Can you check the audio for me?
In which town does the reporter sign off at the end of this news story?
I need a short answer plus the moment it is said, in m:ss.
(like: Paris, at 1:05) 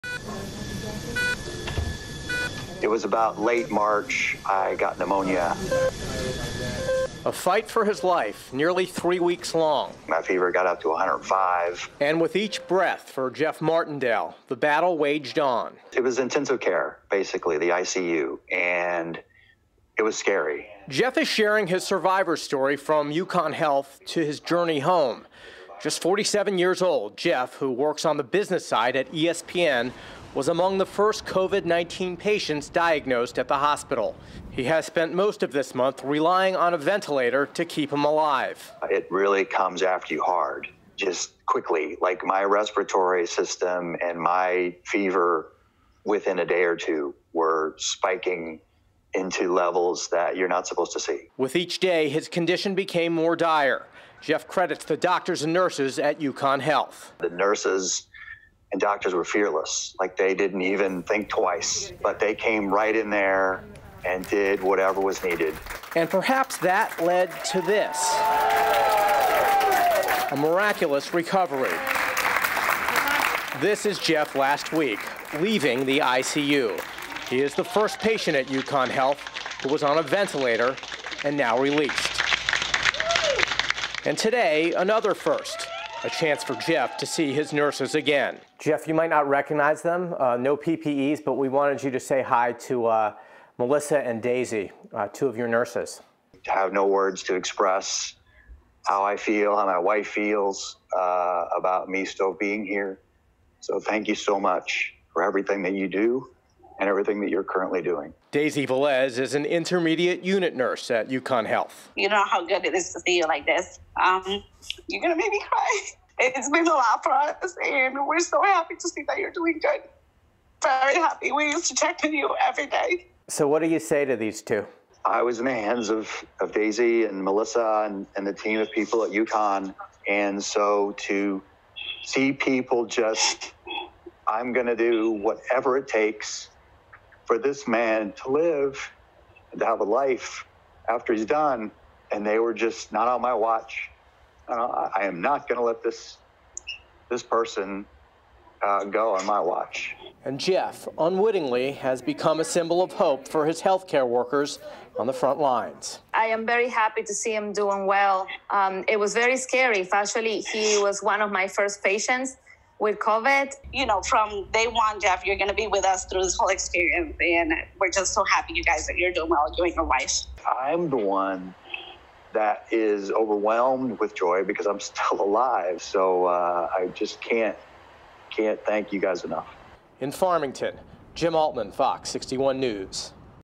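Farmington, at 3:00.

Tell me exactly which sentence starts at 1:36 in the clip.
I have no words to express how I feel, how my wife feels uh, about me still being here.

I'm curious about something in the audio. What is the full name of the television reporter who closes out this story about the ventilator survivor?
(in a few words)
Jim Altman.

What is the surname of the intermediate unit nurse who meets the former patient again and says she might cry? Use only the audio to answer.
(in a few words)
Velez.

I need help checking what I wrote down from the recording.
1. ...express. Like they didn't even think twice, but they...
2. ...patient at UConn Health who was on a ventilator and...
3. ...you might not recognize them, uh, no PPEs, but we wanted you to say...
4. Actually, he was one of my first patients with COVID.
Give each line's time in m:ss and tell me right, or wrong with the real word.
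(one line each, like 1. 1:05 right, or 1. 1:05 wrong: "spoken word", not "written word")
1. 0:59 wrong: "fearless", not "express"
2. 1:17 right
3. 1:28 right
4. 2:39 right.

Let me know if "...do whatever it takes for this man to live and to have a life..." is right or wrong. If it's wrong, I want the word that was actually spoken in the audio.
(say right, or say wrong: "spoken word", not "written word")
right.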